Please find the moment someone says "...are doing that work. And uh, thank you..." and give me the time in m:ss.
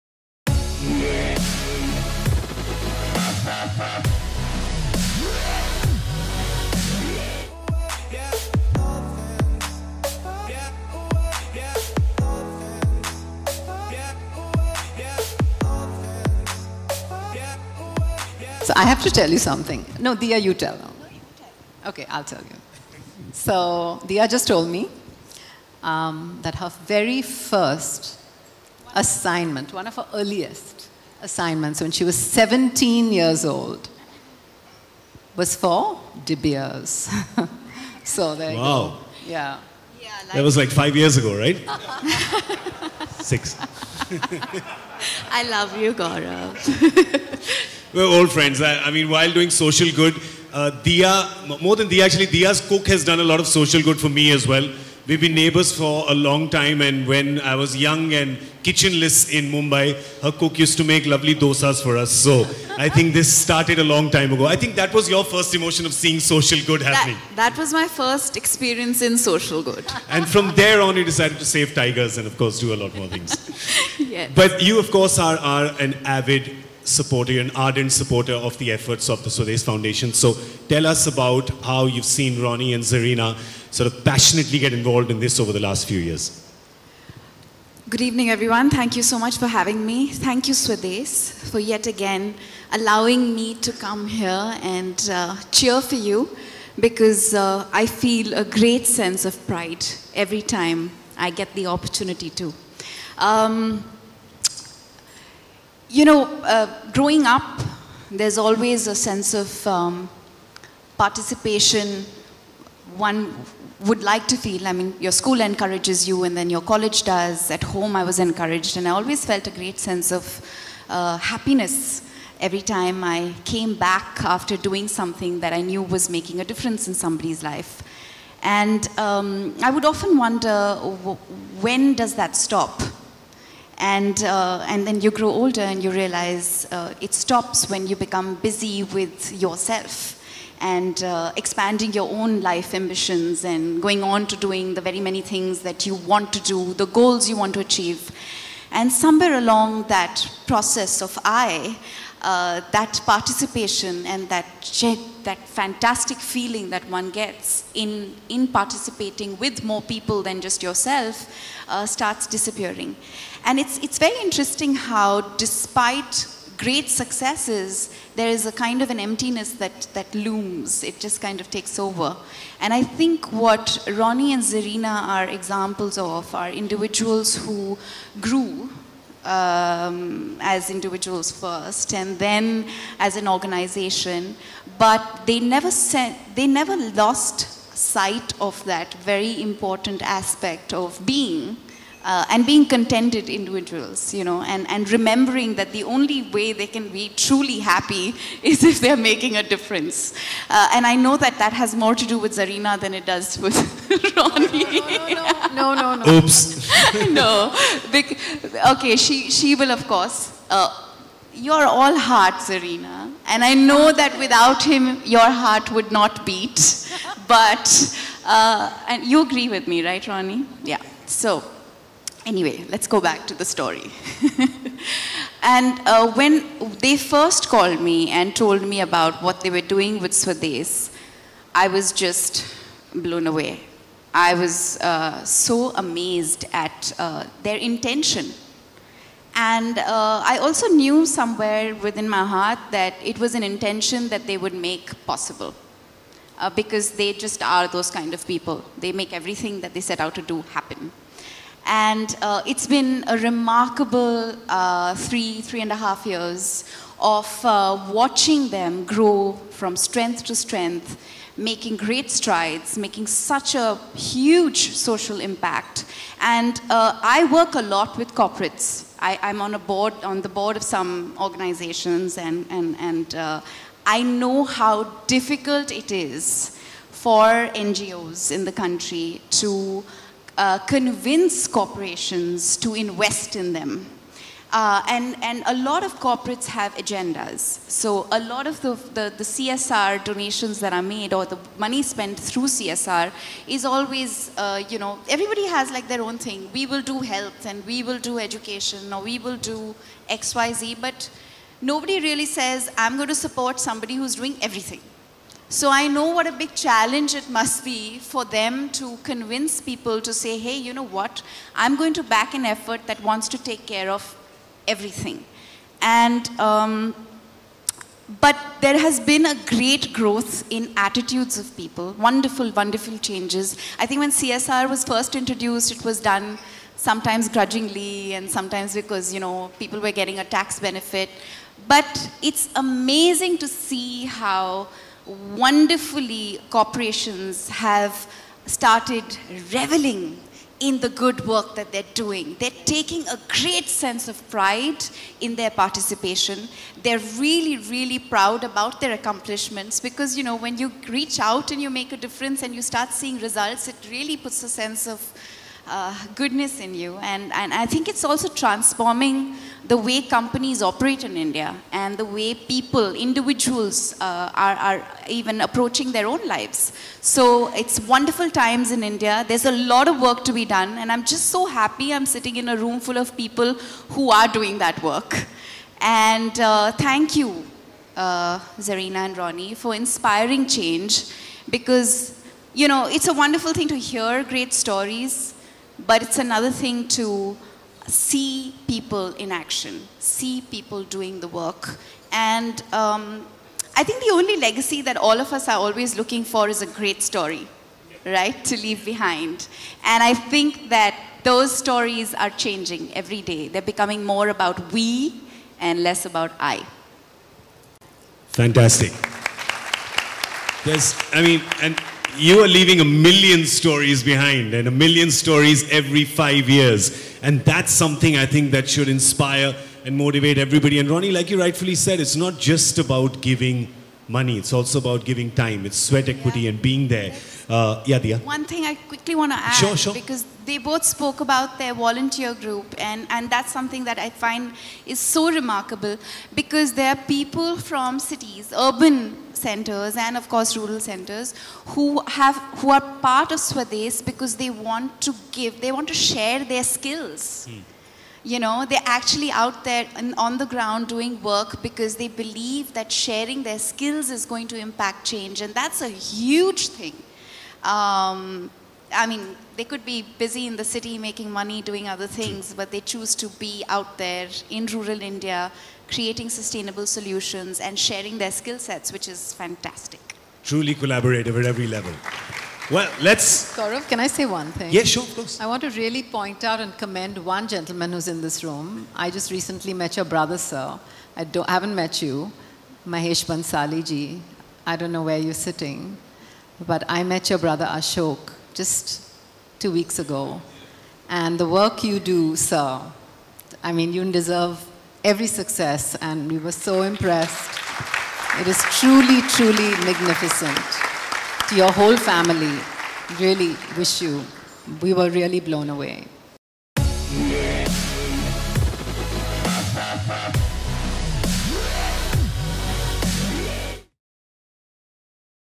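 6:14.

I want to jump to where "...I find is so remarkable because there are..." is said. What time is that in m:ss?
7:13.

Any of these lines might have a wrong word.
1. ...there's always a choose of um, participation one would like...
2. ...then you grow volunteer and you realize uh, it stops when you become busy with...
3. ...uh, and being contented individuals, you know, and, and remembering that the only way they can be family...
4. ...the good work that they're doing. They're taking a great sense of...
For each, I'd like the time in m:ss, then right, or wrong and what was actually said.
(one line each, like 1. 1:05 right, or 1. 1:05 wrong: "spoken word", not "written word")
1. 1:48 wrong: "sense", not "choose"
2. 2:14 wrong: "older", not "volunteer"
3. 3:12 wrong: "truly", not "family"
4. 5:40 right.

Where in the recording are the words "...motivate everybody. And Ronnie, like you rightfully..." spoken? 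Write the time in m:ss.
6:59.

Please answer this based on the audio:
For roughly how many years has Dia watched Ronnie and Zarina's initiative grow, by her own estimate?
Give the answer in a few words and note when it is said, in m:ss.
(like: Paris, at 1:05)
3.5 years, at 4:15.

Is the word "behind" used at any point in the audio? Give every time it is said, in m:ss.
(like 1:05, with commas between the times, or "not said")
6:38, 6:54.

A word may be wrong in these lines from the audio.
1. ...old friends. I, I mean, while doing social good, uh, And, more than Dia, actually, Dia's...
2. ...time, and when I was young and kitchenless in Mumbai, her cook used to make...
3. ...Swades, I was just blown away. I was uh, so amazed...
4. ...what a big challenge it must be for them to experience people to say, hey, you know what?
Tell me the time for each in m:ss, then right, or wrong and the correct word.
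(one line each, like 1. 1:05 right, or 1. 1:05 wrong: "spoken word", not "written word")
1. 0:48 wrong: "Dia", not "And"
2. 0:56 right
3. 3:50 right
4. 5:06 wrong: "convince", not "experience".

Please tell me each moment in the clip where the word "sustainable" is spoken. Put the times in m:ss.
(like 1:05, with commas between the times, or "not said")
7:46.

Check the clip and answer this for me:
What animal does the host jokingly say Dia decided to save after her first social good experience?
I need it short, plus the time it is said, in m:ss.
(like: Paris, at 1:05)
Tigers, at 1:11.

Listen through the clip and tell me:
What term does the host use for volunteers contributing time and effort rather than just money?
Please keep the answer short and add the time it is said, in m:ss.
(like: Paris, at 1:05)
Sweat equity, at 7:05.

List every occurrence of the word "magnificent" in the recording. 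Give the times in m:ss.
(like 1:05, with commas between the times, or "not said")
8:19.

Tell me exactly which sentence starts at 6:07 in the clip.
So it's wonderful times in India.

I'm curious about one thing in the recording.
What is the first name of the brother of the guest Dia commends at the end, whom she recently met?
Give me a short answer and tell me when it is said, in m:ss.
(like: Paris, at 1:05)
Ashok, at 8:07.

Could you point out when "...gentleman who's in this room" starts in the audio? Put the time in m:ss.
7:57.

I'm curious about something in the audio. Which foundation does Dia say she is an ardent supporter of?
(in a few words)
Swades Foundation.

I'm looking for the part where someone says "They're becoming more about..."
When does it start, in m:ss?
6:43.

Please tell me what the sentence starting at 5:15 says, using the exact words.
And, um, but there has been a great growth in attitudes of people, wonderful, wonderful changes.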